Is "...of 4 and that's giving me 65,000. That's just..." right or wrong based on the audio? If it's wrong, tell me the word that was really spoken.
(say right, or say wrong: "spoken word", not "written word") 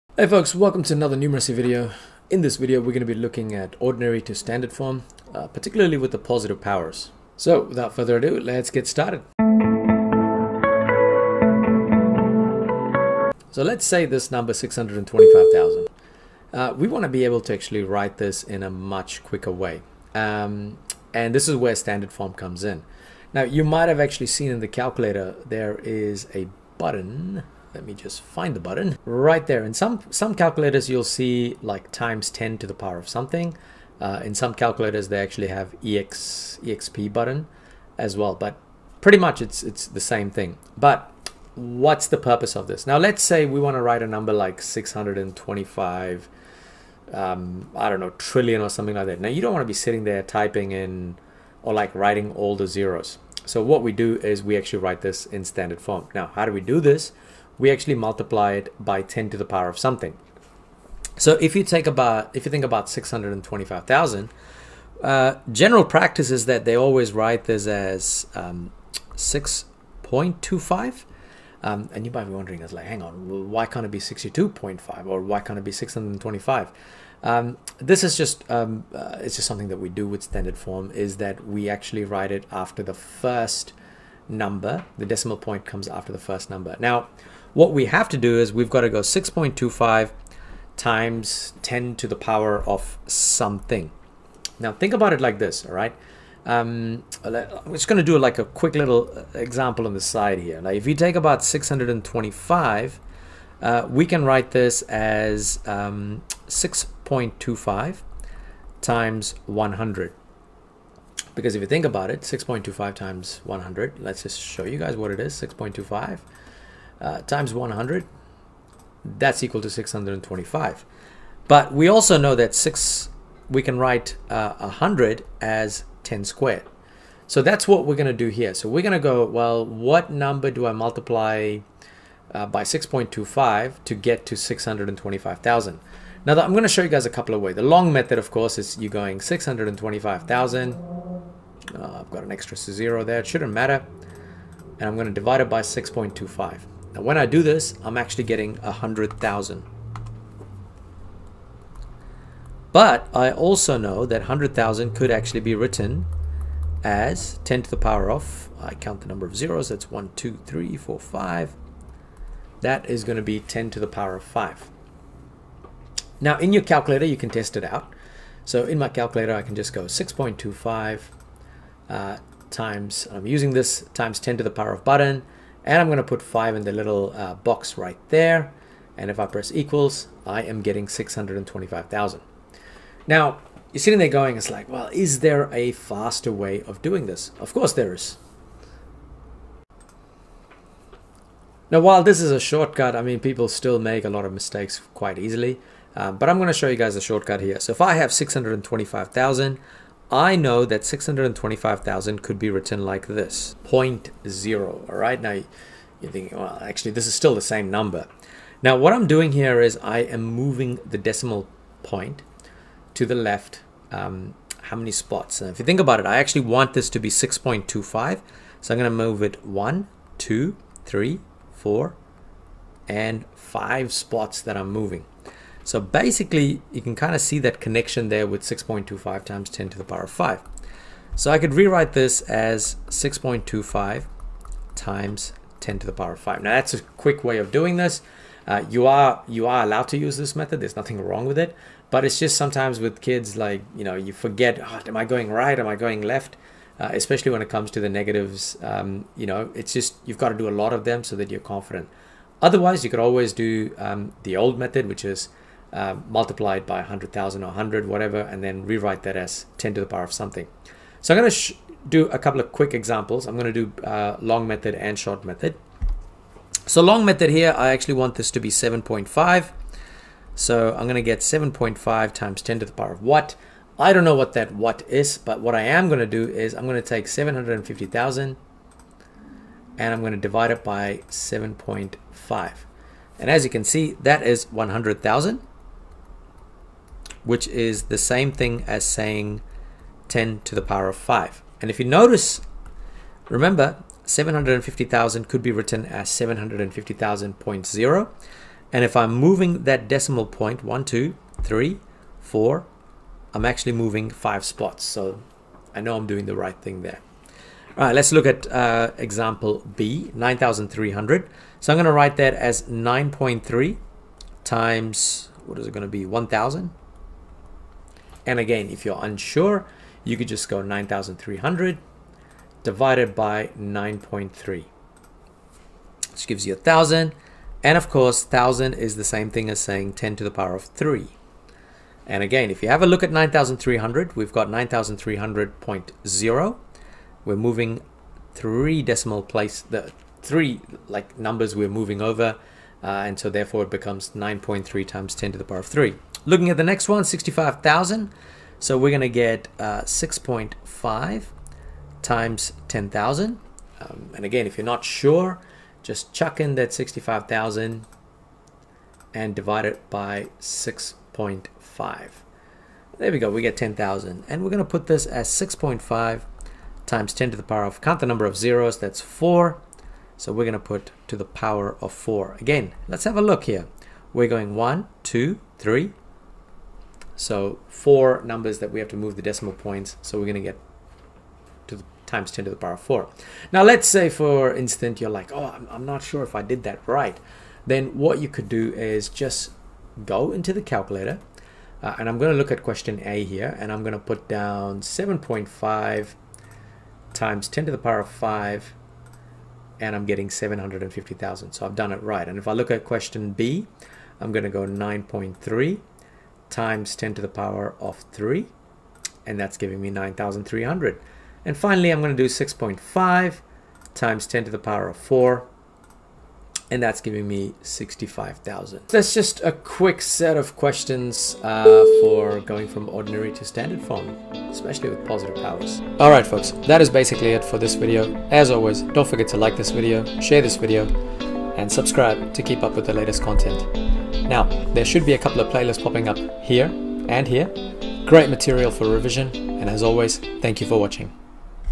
right.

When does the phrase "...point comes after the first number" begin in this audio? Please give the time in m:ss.
1:25.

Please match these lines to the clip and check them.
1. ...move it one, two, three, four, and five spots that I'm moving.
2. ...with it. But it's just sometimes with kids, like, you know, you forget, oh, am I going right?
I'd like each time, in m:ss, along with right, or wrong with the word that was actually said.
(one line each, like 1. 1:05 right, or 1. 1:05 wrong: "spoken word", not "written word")
1. 3:38 right
2. 4:01 right.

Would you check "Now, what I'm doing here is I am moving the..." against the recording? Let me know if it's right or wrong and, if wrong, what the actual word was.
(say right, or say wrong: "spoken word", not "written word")
right.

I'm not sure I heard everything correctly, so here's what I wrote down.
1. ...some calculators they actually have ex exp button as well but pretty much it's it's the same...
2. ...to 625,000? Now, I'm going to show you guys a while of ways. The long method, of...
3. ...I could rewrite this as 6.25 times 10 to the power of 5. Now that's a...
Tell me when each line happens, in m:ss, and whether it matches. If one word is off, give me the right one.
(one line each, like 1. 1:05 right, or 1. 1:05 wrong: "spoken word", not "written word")
1. 0:34 right
2. 2:14 wrong: "couple", not "while"
3. 3:51 right.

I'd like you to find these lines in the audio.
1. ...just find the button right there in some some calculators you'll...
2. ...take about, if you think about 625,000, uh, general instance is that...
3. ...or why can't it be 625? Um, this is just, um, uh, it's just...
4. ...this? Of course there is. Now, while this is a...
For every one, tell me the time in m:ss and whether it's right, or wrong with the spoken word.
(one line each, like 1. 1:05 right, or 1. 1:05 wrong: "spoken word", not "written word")
1. 0:27 right
2. 1:01 wrong: "practice", not "instance"
3. 1:15 right
4. 3:07 right.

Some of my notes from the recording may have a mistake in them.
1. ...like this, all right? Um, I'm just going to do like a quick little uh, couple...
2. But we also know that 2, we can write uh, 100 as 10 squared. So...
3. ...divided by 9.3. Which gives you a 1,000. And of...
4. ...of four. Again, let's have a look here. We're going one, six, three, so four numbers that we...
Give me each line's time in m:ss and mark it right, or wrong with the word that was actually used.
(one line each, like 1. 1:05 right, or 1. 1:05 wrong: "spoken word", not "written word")
1. 1:35 wrong: "example", not "couple"
2. 2:01 wrong: "6", not "2"
3. 5:22 right
4. 6:11 wrong: "two", not "six".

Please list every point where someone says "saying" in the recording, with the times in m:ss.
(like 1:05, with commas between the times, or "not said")
4:48, 5:29.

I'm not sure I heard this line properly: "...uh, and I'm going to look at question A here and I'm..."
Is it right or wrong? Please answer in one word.
right.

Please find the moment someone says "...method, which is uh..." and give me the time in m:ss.
4:14.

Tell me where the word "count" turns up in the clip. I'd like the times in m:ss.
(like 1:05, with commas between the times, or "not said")
2:38, 6:07.